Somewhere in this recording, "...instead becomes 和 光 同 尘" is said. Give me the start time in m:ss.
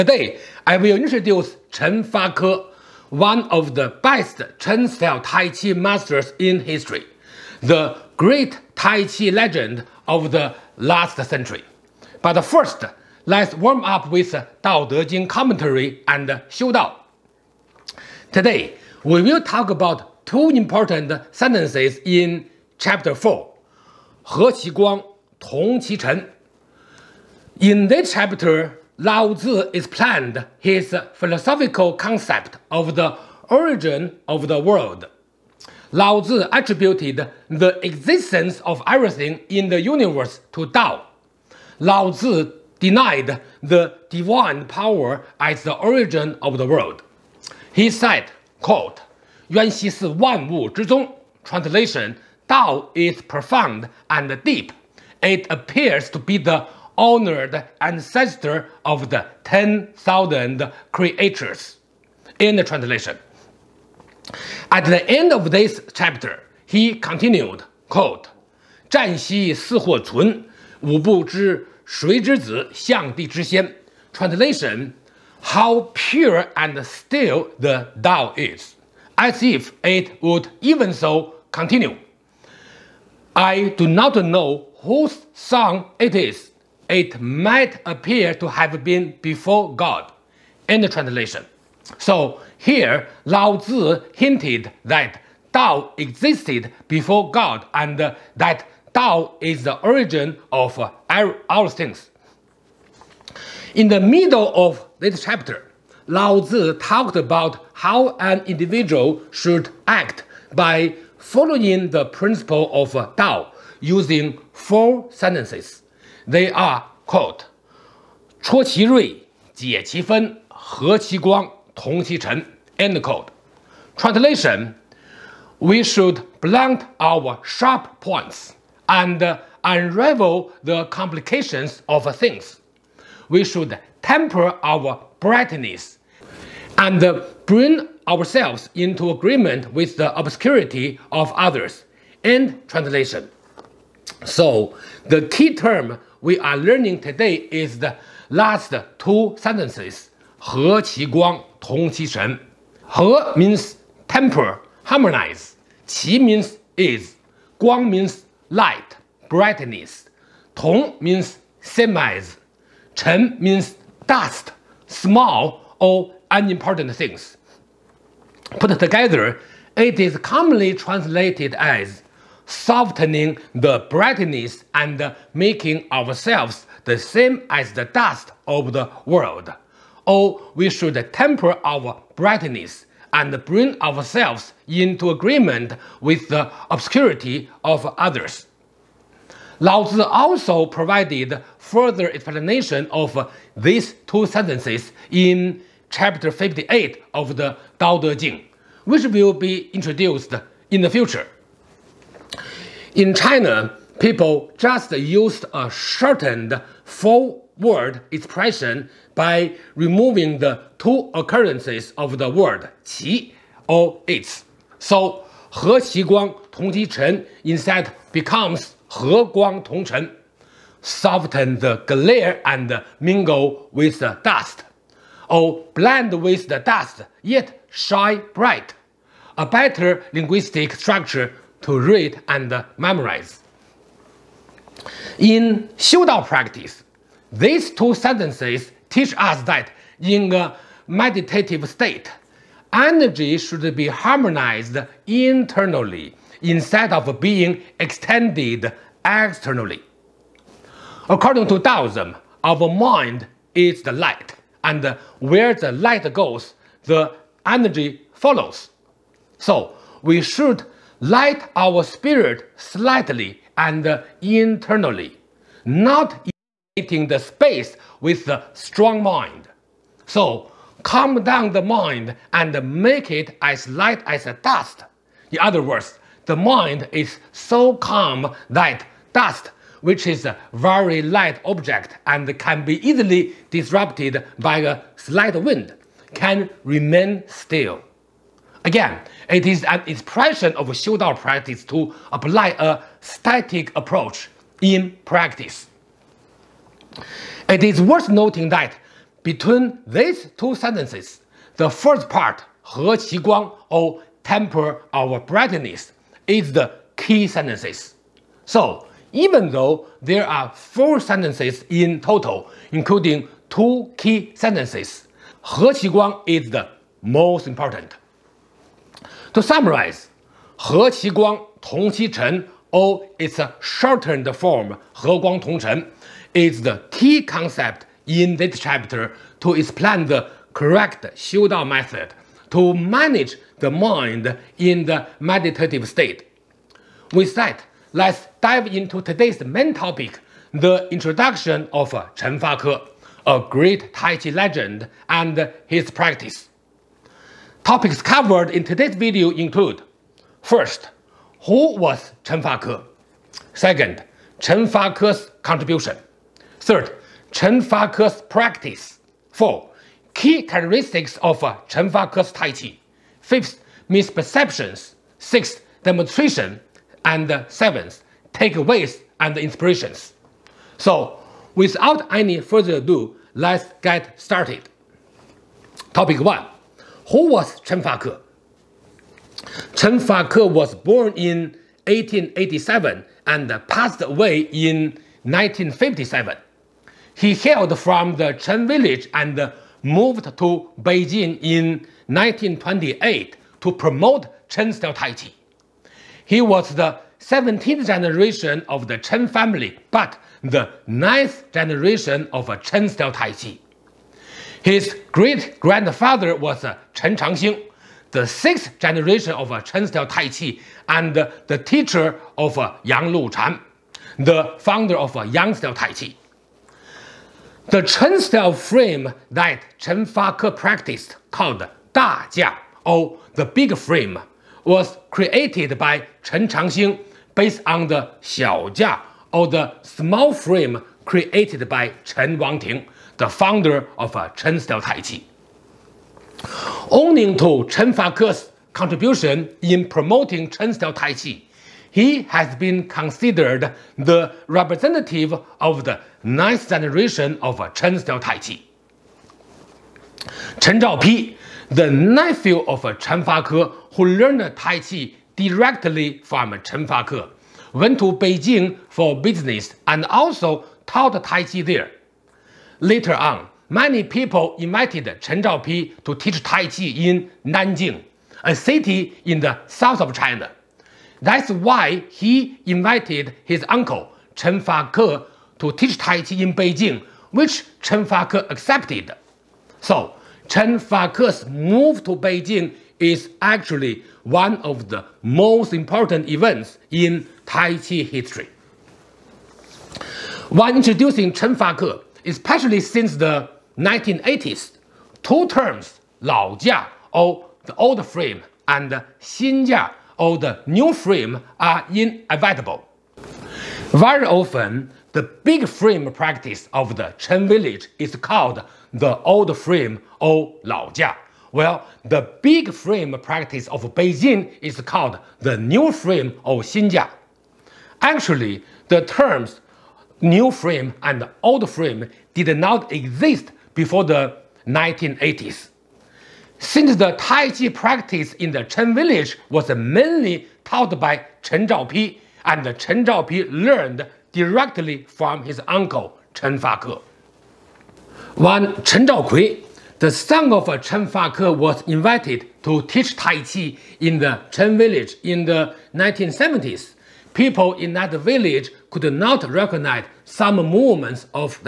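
3:37.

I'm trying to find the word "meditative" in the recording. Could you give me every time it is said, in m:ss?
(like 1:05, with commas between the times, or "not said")
4:00, 5:35.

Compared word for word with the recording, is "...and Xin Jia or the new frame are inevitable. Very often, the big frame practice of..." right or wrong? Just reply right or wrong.
right.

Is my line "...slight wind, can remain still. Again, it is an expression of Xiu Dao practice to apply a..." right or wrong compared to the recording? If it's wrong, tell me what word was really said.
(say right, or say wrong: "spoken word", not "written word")
right.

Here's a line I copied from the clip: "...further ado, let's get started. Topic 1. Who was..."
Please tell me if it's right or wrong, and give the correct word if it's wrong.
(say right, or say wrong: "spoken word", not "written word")
right.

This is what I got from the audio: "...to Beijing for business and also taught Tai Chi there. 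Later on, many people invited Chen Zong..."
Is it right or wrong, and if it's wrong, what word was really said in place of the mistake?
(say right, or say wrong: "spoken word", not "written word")
wrong: "Zhaopi", not "Zong".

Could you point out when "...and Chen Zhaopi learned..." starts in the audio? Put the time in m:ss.
8:52.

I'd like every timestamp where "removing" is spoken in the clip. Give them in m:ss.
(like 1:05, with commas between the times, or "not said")
3:29.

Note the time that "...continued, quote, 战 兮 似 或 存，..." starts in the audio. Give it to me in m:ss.
1:06.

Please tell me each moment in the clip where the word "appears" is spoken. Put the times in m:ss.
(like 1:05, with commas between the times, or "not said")
0:55, 1:27.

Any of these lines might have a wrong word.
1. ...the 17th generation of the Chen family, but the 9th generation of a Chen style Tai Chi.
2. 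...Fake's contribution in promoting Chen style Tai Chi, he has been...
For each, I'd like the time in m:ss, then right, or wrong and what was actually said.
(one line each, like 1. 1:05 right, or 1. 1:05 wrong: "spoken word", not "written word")
1. 6:36 right
2. 7:17 right.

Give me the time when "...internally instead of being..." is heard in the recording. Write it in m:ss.
4:05.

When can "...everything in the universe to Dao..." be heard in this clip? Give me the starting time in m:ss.
0:38.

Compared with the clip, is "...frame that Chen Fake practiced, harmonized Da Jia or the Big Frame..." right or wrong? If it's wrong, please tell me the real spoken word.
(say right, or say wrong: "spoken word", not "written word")
wrong: "called", not "harmonized".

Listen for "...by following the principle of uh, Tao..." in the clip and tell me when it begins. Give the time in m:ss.
1:50.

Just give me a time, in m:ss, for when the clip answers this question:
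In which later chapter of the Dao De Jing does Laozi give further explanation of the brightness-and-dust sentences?
3:15.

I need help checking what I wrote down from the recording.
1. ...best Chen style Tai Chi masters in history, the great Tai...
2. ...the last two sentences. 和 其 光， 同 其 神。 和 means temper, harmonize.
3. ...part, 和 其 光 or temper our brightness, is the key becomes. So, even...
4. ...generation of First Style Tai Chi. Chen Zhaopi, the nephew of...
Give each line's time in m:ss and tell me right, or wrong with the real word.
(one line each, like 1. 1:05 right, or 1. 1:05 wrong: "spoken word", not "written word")
1. 0:04 right
2. 2:27 right
3. 5:02 wrong: "sentences", not "becomes"
4. 7:26 wrong: "Chen", not "First".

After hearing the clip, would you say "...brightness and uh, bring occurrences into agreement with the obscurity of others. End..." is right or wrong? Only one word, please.
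wrong.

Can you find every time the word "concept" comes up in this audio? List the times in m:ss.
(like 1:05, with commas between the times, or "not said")
0:31, 5:27.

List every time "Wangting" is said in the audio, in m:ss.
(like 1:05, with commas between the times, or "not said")
7:12.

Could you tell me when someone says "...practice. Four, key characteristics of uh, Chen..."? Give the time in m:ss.
5:58.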